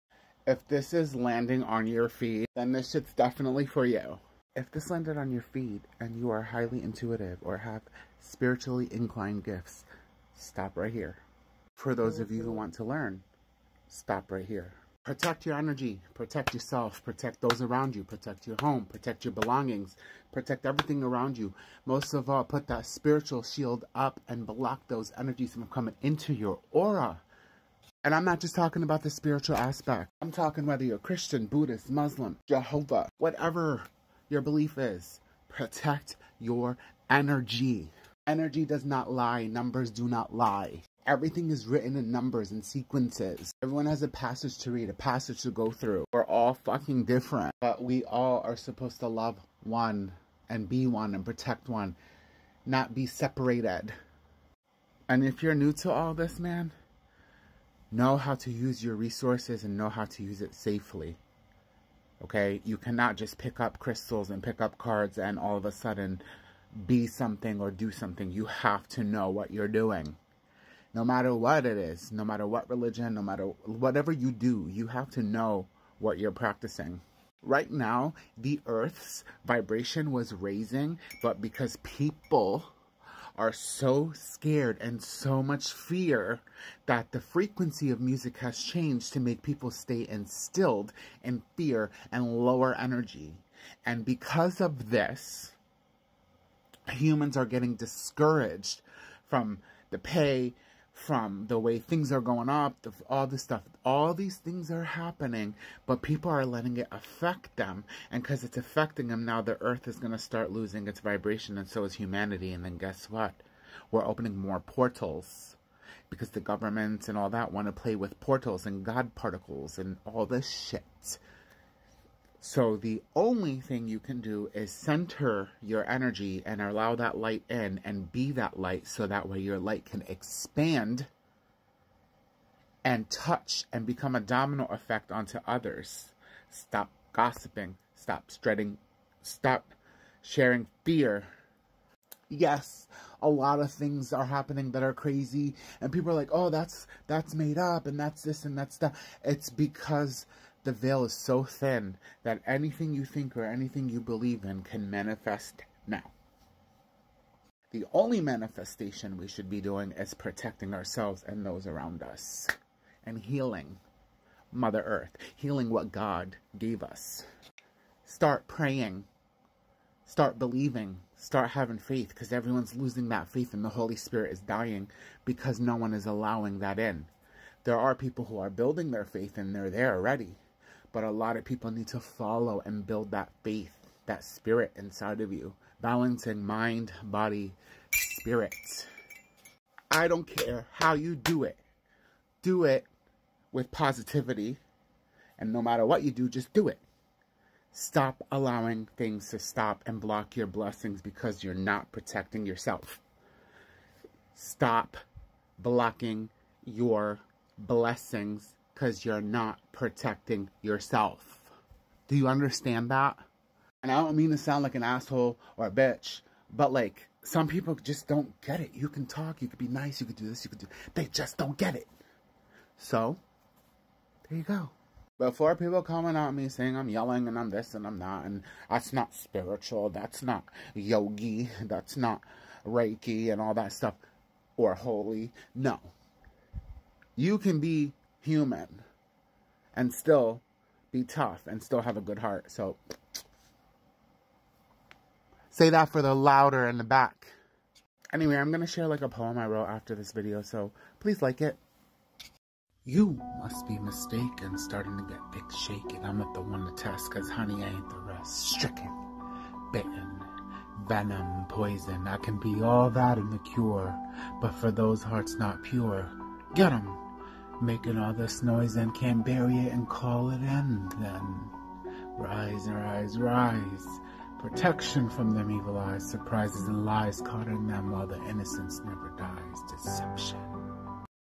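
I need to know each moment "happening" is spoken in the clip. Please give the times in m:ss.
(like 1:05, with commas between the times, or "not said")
1:44, 2:24.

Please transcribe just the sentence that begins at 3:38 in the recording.
You can talk, you could be nice, you could do this, you could do they just don't get it.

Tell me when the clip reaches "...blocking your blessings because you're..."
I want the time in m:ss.
3:25.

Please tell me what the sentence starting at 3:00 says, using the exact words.
But a lot of people need to follow and build that faith, that spirit inside of you.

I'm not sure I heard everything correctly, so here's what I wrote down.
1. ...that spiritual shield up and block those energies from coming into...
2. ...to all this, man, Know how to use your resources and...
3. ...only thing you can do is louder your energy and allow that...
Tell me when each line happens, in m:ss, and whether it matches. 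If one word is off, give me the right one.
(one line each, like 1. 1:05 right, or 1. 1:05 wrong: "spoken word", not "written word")
1. 0:22 right
2. 0:55 right
3. 2:03 wrong: "center", not "louder".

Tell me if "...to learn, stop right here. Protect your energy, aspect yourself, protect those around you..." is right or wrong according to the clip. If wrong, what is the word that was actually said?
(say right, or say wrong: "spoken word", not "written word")
wrong: "protect", not "aspect".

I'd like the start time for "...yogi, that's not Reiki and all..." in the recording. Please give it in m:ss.
3:50.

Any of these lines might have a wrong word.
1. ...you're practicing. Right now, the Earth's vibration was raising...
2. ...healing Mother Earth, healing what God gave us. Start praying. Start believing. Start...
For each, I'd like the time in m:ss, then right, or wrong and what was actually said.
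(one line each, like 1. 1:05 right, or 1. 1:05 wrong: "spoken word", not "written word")
1. 1:16 right
2. 2:43 right.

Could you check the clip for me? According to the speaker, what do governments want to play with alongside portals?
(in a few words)
God particles.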